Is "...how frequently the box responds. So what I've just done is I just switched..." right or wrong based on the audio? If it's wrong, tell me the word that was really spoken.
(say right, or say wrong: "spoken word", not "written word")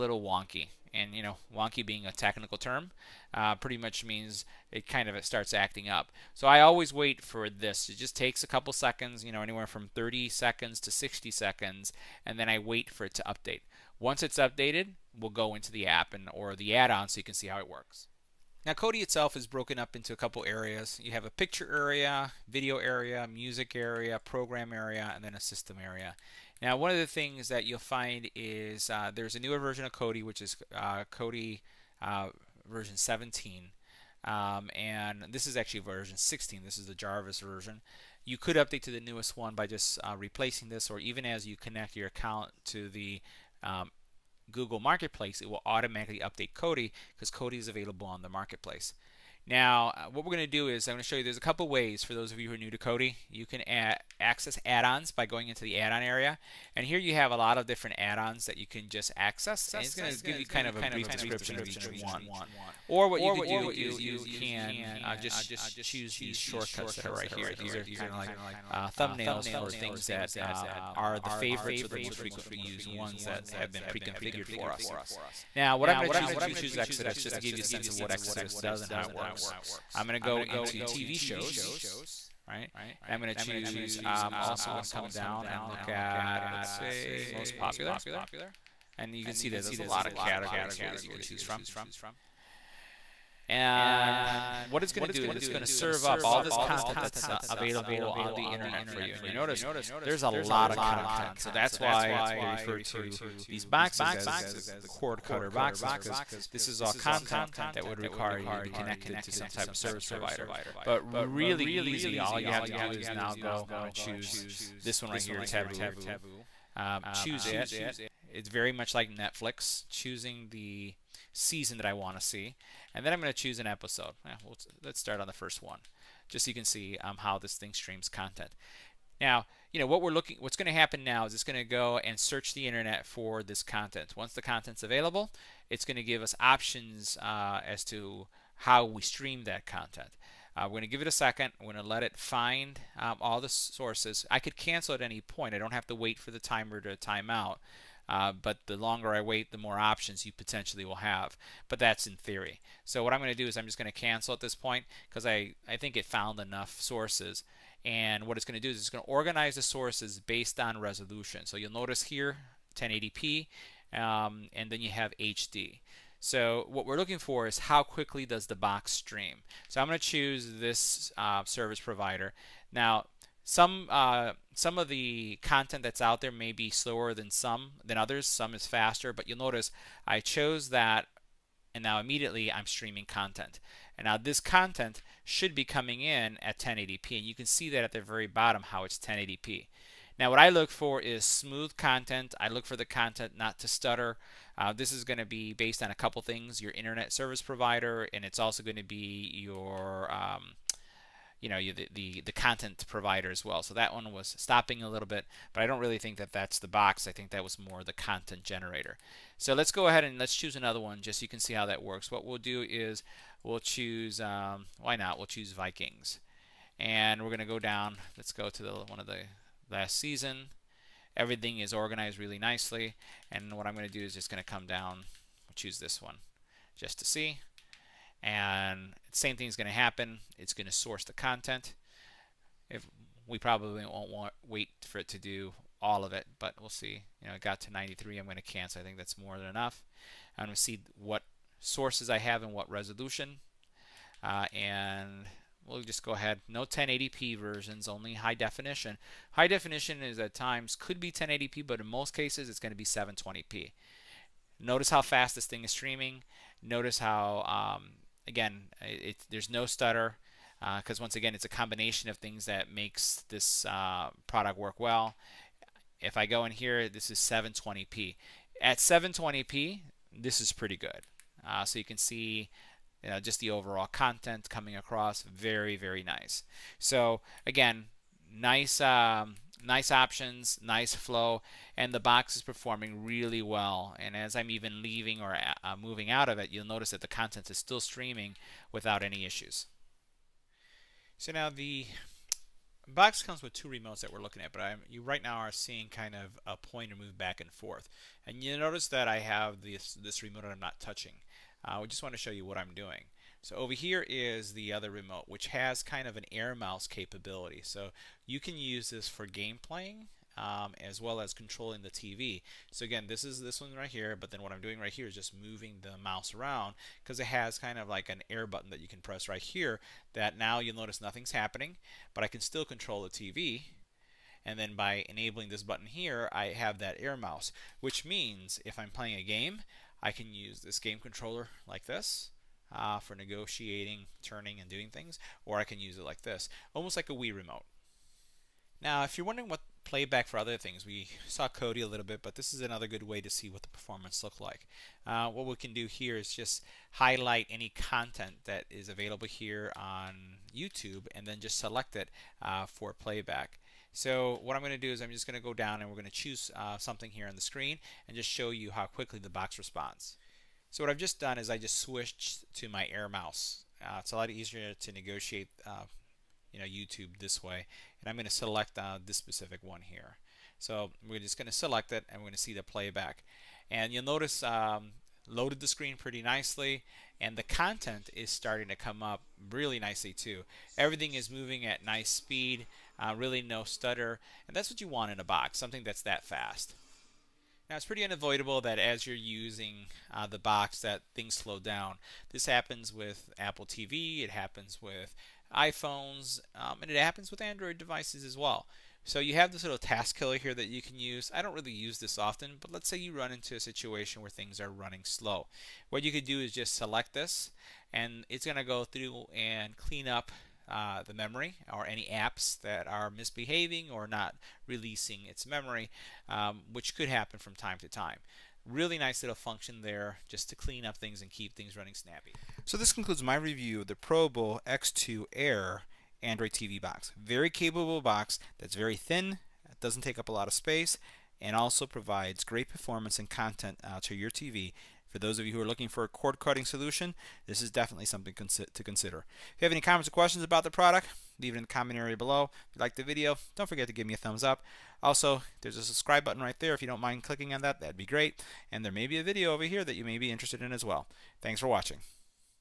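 wrong: "quickly", not "frequently".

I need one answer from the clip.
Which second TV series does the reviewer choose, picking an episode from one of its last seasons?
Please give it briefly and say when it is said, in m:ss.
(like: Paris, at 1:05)
Vikings, at 3:35.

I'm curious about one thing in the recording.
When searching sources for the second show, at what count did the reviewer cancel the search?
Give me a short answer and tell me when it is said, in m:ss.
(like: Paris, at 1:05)
93, at 3:57.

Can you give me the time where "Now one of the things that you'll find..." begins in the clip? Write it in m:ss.
0:26.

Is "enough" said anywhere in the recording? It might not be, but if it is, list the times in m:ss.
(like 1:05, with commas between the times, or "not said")
2:36, 3:59.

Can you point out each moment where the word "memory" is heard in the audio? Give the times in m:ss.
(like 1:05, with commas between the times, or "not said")
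6:51, 6:55.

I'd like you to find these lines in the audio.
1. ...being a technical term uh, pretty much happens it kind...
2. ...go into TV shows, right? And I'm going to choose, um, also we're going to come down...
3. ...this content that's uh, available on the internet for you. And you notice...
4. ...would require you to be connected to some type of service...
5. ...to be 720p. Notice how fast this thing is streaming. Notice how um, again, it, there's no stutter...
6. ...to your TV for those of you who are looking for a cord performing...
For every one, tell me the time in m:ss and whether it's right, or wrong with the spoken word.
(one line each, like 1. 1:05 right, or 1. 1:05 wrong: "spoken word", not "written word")
1. 0:01 wrong: "means", not "happens"
2. 1:20 right
3. 1:36 right
4. 1:47 right
5. 4:12 right
6. 7:14 wrong: "cutting", not "performing".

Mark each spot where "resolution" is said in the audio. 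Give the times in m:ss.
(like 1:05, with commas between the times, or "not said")
2:40, 4:02.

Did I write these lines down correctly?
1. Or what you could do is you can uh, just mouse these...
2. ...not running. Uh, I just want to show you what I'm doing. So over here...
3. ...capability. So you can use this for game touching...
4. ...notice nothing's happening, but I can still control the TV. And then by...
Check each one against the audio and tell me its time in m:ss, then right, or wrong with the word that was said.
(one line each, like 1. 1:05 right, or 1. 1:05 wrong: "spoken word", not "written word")
1. 1:02 wrong: "choose", not "mouse"
2. 5:00 wrong: "touching", not "running"
3. 5:06 wrong: "playing", not "touching"
4. 5:20 right.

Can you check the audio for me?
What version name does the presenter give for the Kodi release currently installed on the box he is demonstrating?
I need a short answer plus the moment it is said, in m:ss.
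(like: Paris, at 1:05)
Jarvis, at 0:36.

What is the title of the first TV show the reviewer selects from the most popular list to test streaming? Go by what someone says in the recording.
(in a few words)
Taboo.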